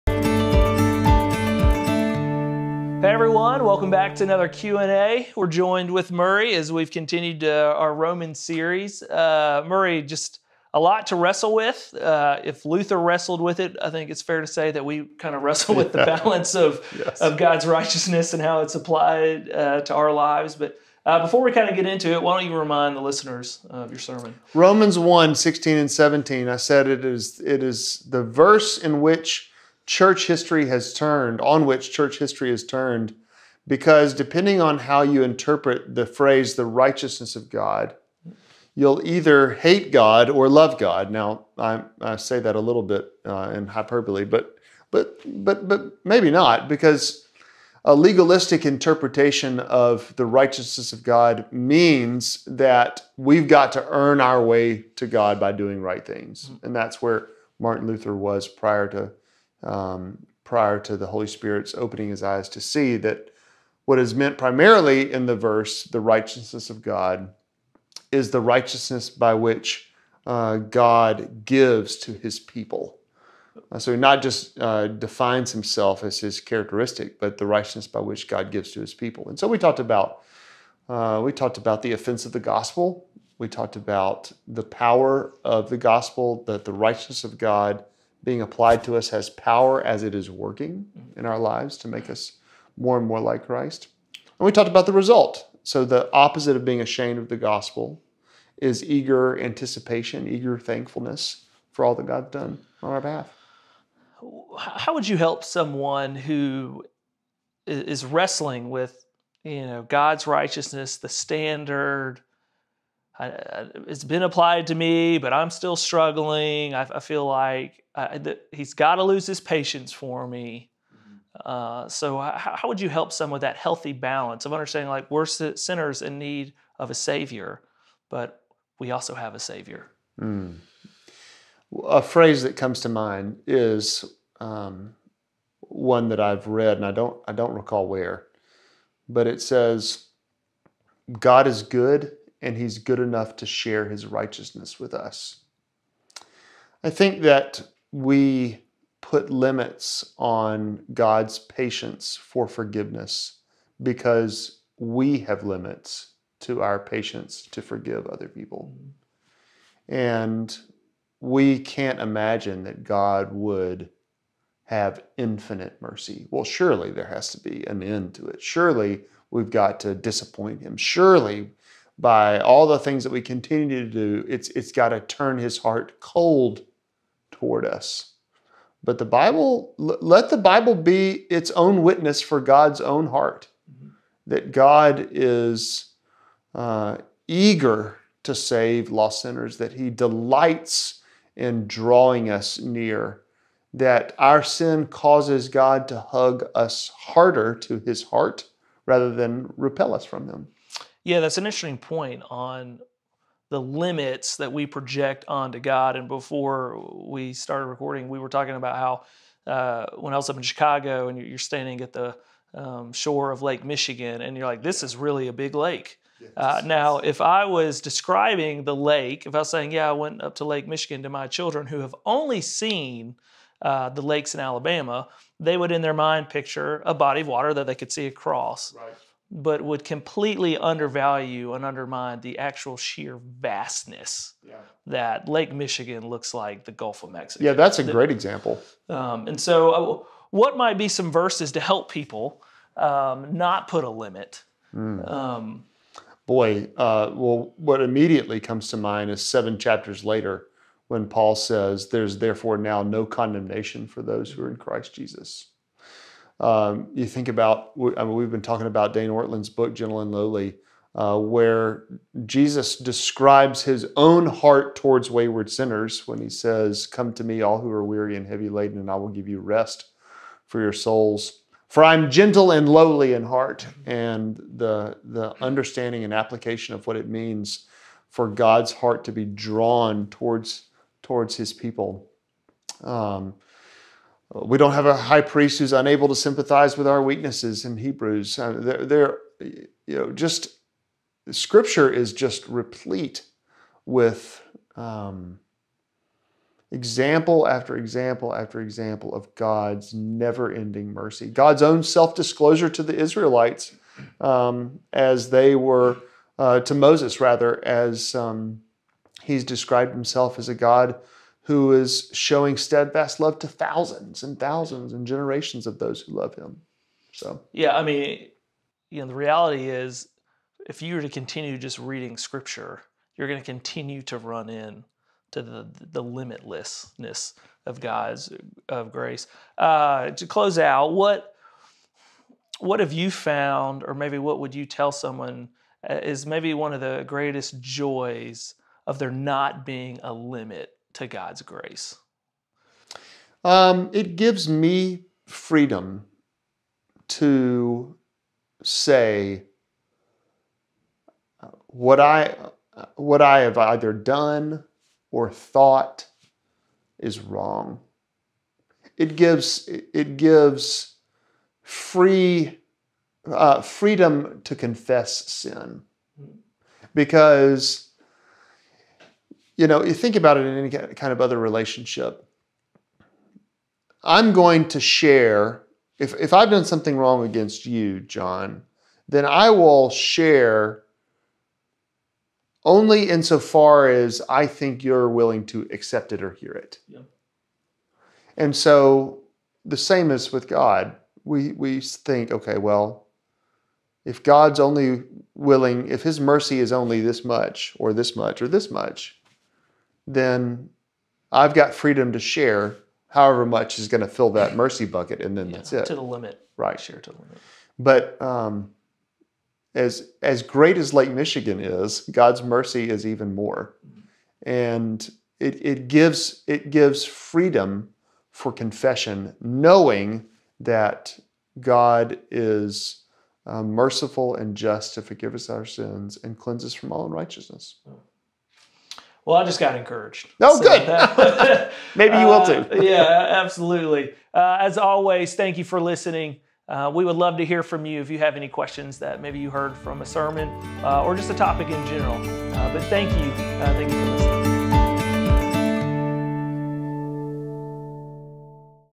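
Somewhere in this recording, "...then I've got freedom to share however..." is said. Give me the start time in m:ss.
6:40.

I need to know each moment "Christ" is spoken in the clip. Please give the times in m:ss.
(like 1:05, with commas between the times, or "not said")
1:33, 4:14.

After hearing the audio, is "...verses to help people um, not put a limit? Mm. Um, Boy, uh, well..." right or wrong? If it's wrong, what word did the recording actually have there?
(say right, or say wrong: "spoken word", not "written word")
right.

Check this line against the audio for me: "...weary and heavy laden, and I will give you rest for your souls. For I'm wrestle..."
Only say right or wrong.
wrong.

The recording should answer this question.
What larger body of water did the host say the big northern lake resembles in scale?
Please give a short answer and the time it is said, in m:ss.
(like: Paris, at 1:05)
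Gulf of Mexico, at 3:56.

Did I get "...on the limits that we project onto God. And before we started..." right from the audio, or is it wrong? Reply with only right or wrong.
right.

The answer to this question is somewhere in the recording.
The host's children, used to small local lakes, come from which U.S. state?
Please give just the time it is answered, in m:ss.
3:44.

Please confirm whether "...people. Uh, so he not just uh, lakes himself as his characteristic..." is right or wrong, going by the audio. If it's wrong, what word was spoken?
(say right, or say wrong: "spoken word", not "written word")
wrong: "defines", not "lakes".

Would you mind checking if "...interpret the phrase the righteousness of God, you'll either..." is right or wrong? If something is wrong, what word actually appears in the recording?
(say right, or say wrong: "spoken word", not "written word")
right.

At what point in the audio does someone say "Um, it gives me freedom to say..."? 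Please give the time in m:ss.
5:43.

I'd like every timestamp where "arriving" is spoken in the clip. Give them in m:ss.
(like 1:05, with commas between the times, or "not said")
not said.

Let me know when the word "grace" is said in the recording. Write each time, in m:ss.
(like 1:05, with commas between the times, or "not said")
5:28, 5:41.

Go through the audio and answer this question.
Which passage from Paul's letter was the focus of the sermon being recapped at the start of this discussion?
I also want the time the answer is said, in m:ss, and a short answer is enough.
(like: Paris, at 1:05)
Romans 1:16-17, at 0:24.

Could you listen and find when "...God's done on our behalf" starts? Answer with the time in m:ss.
1:42.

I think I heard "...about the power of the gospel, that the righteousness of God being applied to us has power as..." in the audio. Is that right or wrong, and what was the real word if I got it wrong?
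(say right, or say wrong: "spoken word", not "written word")
right.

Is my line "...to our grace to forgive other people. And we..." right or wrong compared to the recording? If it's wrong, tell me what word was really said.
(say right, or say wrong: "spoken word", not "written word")
wrong: "patience", not "grace".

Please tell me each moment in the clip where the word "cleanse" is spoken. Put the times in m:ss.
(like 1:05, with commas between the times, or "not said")
7:06.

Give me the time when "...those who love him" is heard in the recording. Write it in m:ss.
5:15.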